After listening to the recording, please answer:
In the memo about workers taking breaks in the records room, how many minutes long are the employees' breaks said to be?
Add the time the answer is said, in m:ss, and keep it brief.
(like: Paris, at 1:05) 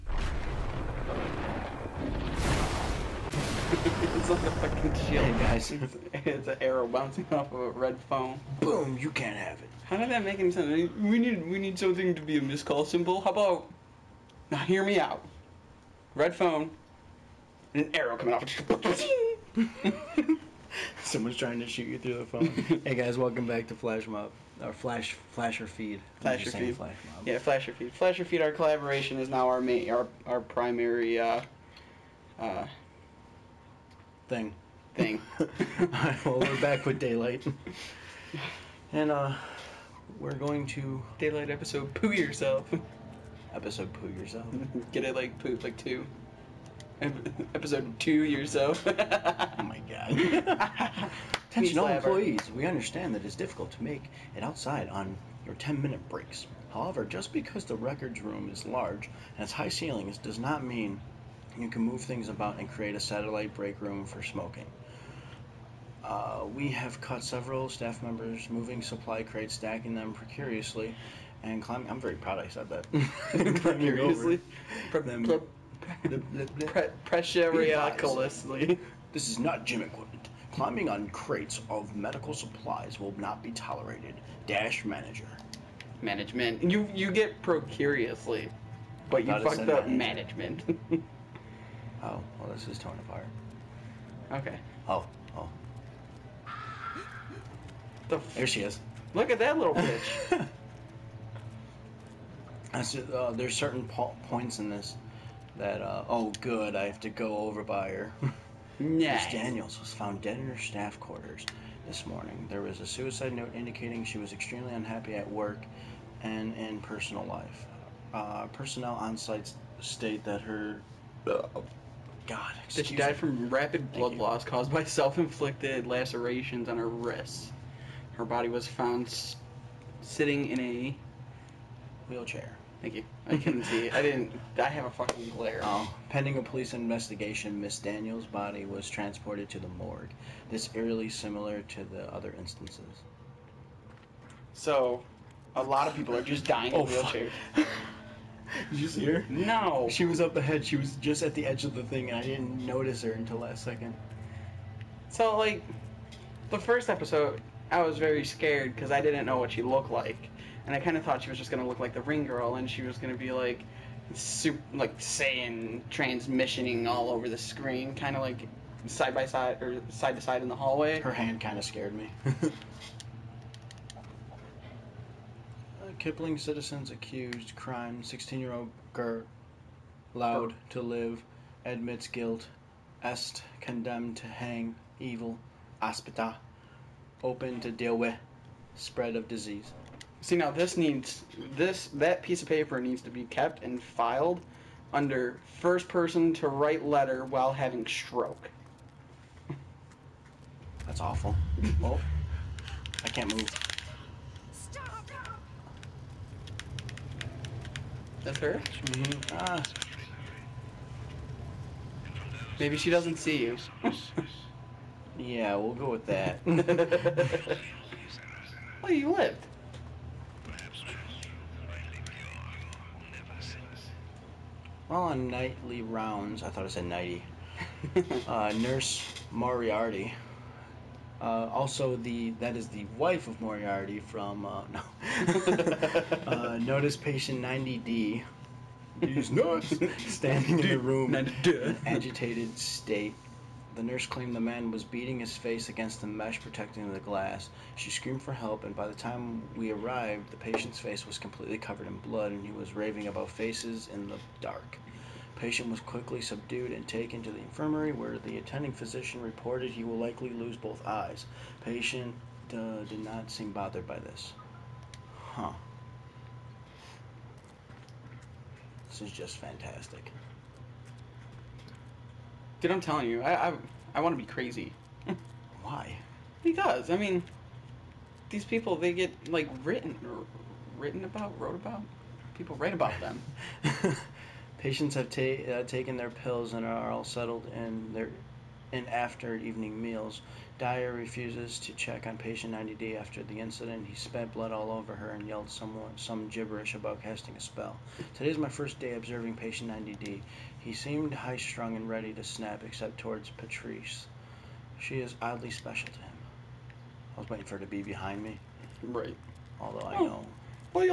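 10, at 0:55.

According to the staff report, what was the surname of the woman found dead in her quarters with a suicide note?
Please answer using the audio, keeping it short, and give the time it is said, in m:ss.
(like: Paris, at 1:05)
Daniels, at 1:49.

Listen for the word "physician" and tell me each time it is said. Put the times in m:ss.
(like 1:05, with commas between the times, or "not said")
4:18.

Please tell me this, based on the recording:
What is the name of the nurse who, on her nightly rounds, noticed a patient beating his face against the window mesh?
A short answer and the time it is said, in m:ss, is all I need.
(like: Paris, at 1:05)
Nurse Moriarty, at 3:48.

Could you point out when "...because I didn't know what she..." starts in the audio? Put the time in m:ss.
2:38.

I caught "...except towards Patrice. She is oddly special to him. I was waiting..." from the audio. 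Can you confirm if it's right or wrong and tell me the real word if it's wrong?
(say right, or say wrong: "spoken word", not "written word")
right.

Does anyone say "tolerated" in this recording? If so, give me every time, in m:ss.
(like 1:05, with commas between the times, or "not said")
1:23.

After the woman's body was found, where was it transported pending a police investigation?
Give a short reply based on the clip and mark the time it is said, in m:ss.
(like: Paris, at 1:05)
The morgue, at 2:19.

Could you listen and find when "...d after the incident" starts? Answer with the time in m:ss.
4:52.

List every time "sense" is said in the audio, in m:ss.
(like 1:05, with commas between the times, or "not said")
0:10.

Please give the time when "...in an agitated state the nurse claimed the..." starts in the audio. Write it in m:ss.
4:01.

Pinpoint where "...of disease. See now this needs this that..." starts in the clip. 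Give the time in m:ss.
3:09.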